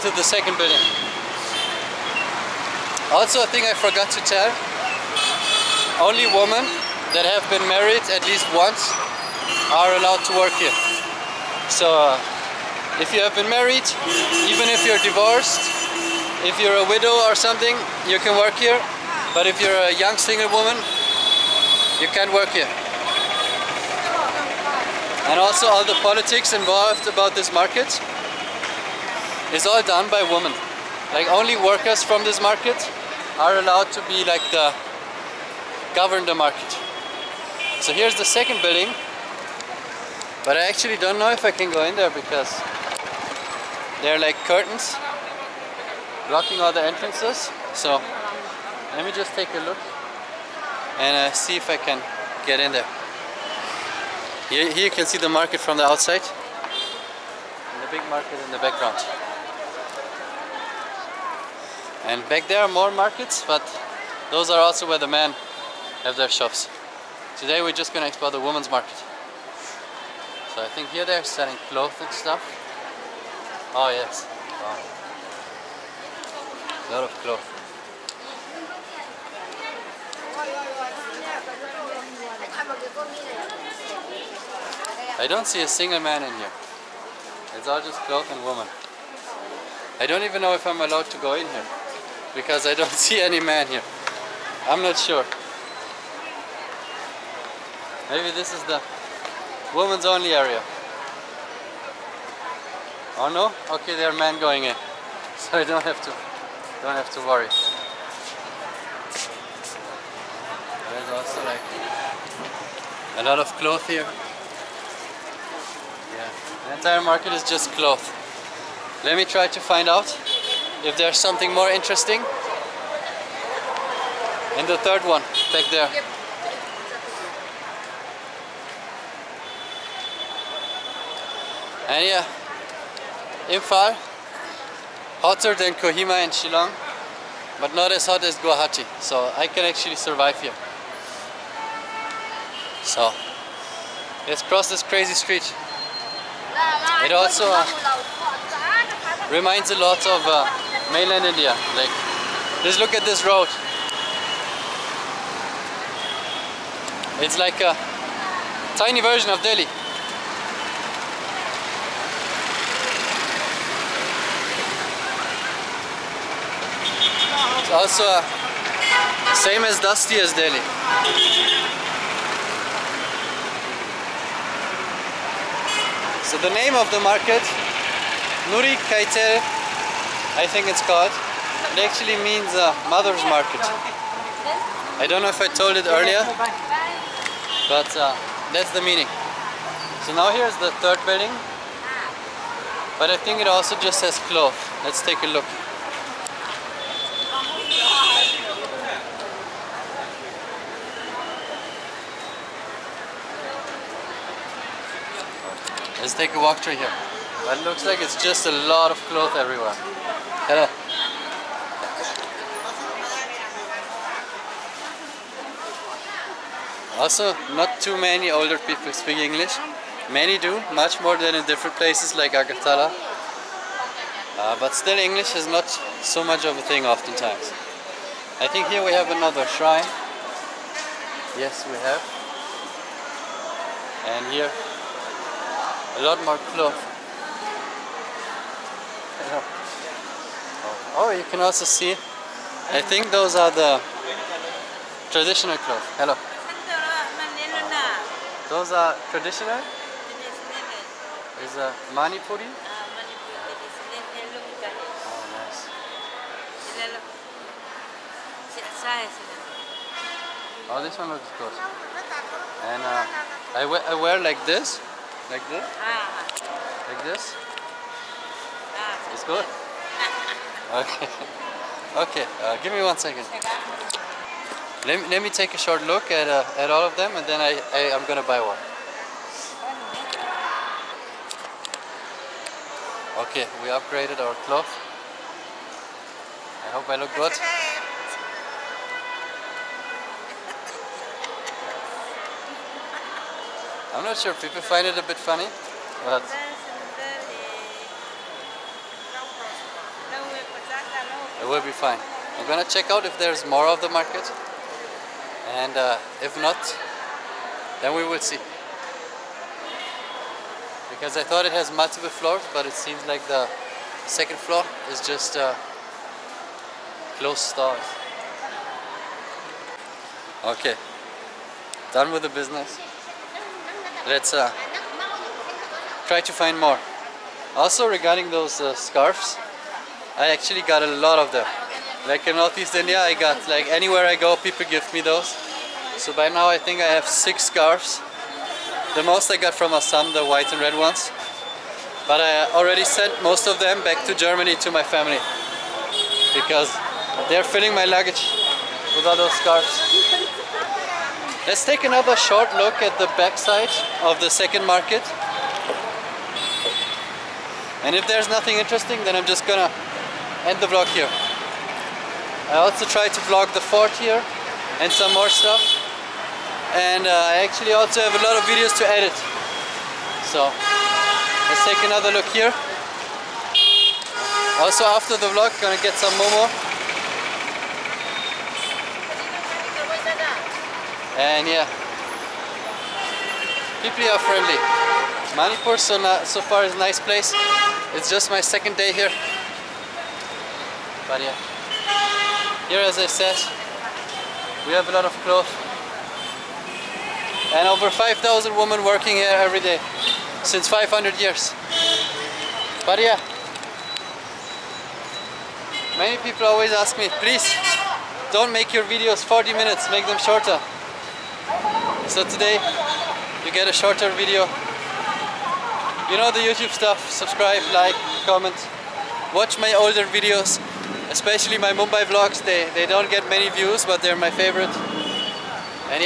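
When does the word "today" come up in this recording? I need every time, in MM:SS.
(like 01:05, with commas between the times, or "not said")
01:07, 06:52.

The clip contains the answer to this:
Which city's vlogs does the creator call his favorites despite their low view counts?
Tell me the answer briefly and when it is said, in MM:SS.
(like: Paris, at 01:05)
Mumbai, at 07:01.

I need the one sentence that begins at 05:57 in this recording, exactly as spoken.
And if there's nothing interesting, then I'm just gonna end the vlog here.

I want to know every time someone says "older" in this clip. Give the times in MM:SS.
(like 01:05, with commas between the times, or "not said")
03:38, 06:59.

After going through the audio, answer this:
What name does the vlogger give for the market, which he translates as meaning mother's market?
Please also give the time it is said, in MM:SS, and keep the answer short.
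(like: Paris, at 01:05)
Nuri Keithel, at 02:58.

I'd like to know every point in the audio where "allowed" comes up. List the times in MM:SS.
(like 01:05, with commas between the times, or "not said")
00:09, 00:33, 01:30.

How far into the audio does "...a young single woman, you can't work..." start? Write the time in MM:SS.
00:19.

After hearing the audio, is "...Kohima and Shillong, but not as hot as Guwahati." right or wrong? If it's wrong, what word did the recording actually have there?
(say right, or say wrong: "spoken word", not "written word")
right.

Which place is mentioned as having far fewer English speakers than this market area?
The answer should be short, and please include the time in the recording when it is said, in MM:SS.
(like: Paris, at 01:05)
Agartala, at 03:42.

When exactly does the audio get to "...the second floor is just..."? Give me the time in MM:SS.
05:13.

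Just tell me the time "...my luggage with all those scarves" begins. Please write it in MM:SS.
05:47.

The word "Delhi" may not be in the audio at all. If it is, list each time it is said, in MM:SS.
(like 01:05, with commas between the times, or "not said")
02:39, 02:50.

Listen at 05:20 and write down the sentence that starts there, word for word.
Okay, done with the business let's uh, try to find more.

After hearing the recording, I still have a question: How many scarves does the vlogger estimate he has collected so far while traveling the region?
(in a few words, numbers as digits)
6.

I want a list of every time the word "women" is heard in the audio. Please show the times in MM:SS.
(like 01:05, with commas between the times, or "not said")
00:30, 01:08, 01:28, 01:39, 06:38.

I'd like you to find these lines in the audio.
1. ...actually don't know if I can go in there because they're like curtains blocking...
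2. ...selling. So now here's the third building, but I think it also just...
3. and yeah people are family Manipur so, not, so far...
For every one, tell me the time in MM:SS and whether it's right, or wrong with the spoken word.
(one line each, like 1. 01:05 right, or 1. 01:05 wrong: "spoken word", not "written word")
1. 00:40 right
2. 03:08 wrong: "meaning", not "selling"
3. 06:21 wrong: "friendly", not "family".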